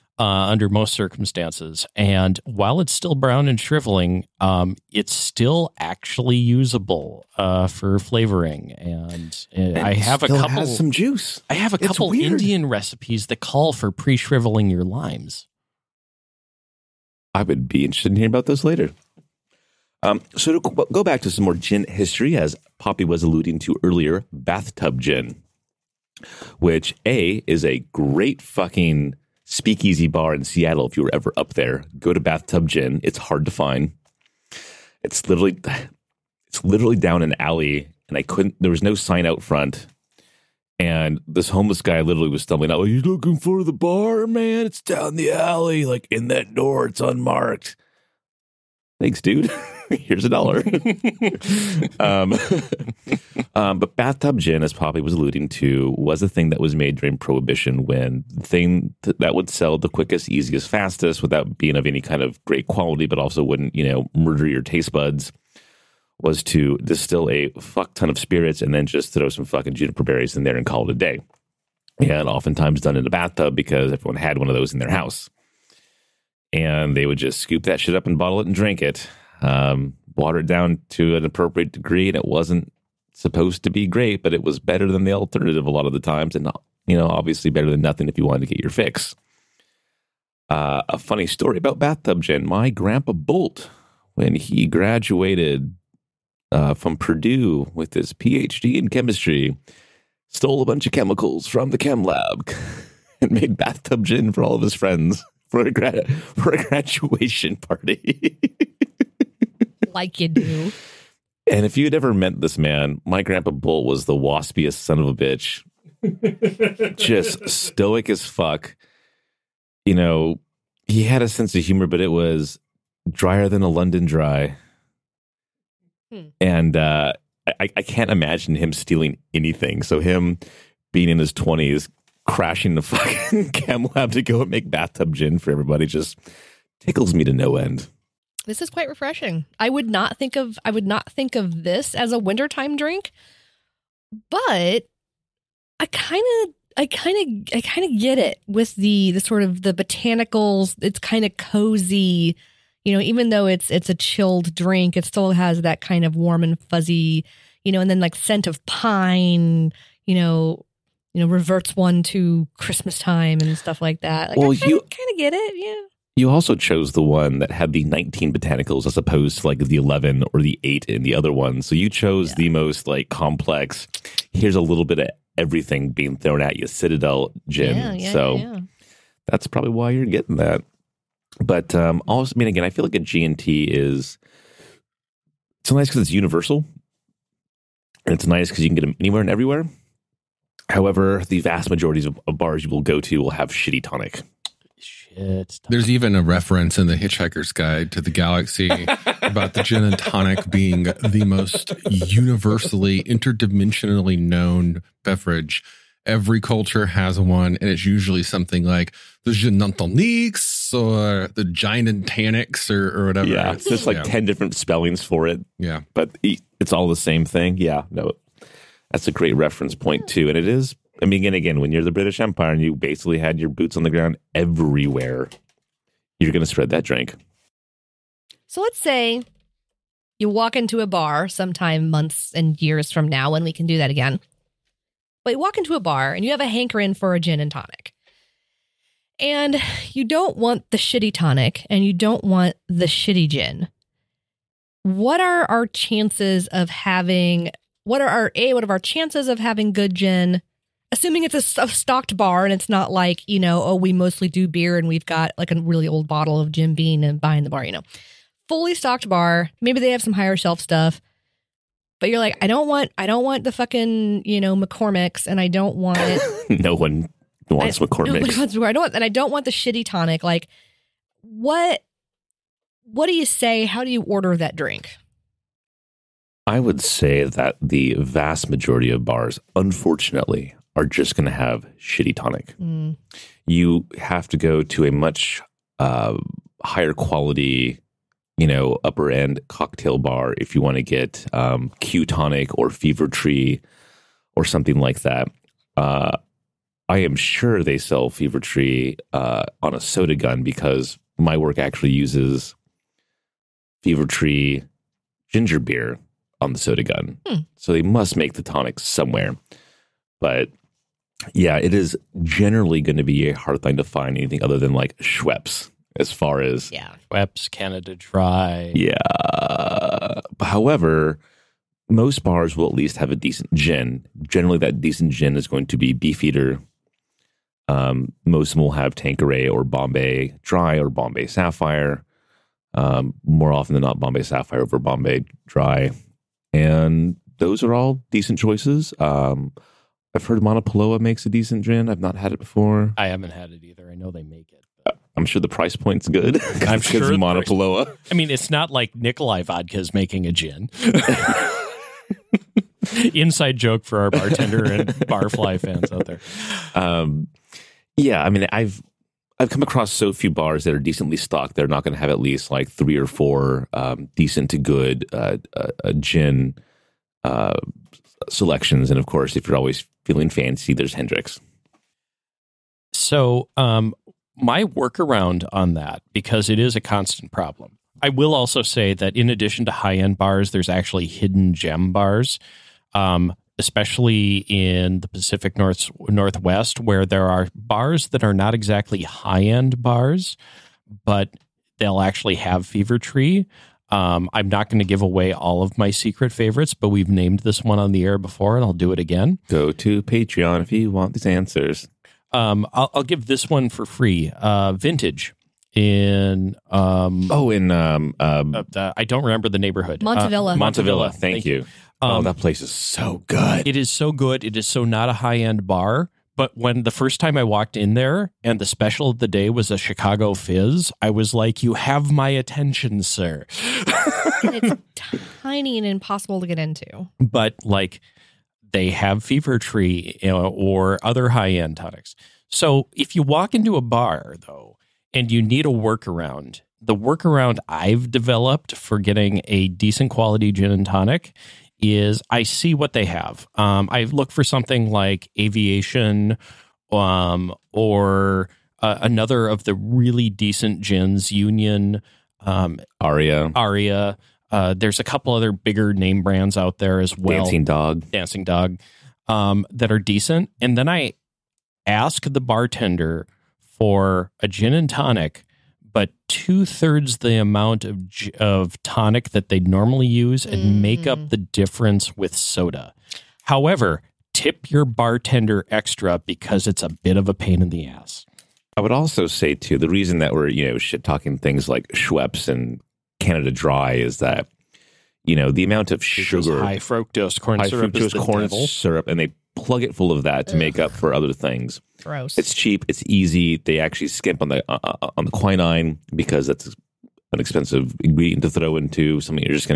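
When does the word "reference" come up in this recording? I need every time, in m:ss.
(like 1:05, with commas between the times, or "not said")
3:16, 3:39.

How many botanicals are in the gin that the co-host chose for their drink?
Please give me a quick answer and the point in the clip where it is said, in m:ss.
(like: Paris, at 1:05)
19, at 2:47.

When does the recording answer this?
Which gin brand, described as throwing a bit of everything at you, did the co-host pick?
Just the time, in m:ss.
2:56.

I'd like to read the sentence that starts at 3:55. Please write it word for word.
But you walk into a bar and you have a hankering for a gin and tonic.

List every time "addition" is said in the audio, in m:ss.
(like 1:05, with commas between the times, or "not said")
6:19.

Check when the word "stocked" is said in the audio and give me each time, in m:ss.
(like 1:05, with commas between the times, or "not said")
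4:11, 4:18, 6:01.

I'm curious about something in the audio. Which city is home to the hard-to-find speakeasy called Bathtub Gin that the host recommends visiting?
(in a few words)
Seattle.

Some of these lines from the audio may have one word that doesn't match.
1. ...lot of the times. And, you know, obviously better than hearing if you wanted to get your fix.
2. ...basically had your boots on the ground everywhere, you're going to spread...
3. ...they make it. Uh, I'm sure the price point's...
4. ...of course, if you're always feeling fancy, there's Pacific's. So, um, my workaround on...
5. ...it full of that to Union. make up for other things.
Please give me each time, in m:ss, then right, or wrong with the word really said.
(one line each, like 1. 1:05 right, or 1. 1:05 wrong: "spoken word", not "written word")
1. 1:25 wrong: "nothing", not "hearing"
2. 3:42 right
3. 5:44 right
4. 6:08 wrong: "Hendrick", not "Pacific"
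5. 8:09 wrong: "Ugh", not "Union".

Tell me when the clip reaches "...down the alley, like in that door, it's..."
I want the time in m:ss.
0:44.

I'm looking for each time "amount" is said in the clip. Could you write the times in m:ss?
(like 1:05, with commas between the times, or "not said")
7:47, 8:05.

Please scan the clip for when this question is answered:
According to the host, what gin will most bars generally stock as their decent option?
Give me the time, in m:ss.
5:25.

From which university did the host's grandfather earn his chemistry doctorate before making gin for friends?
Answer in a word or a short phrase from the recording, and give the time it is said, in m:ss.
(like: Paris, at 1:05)
Purdue, at 1:36.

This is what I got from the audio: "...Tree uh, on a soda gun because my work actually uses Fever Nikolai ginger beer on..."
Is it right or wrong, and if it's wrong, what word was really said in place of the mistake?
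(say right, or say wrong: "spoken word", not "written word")
wrong: "Tree", not "Nikolai".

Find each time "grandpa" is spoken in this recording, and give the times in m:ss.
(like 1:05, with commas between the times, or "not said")
1:32, 1:53.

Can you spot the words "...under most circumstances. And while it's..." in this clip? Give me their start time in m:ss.
0:00.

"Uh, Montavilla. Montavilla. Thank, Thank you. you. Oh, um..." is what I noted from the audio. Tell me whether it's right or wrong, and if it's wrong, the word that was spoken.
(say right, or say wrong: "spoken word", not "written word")
right.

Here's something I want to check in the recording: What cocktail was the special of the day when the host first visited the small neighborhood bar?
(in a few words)
Chicago Fizz.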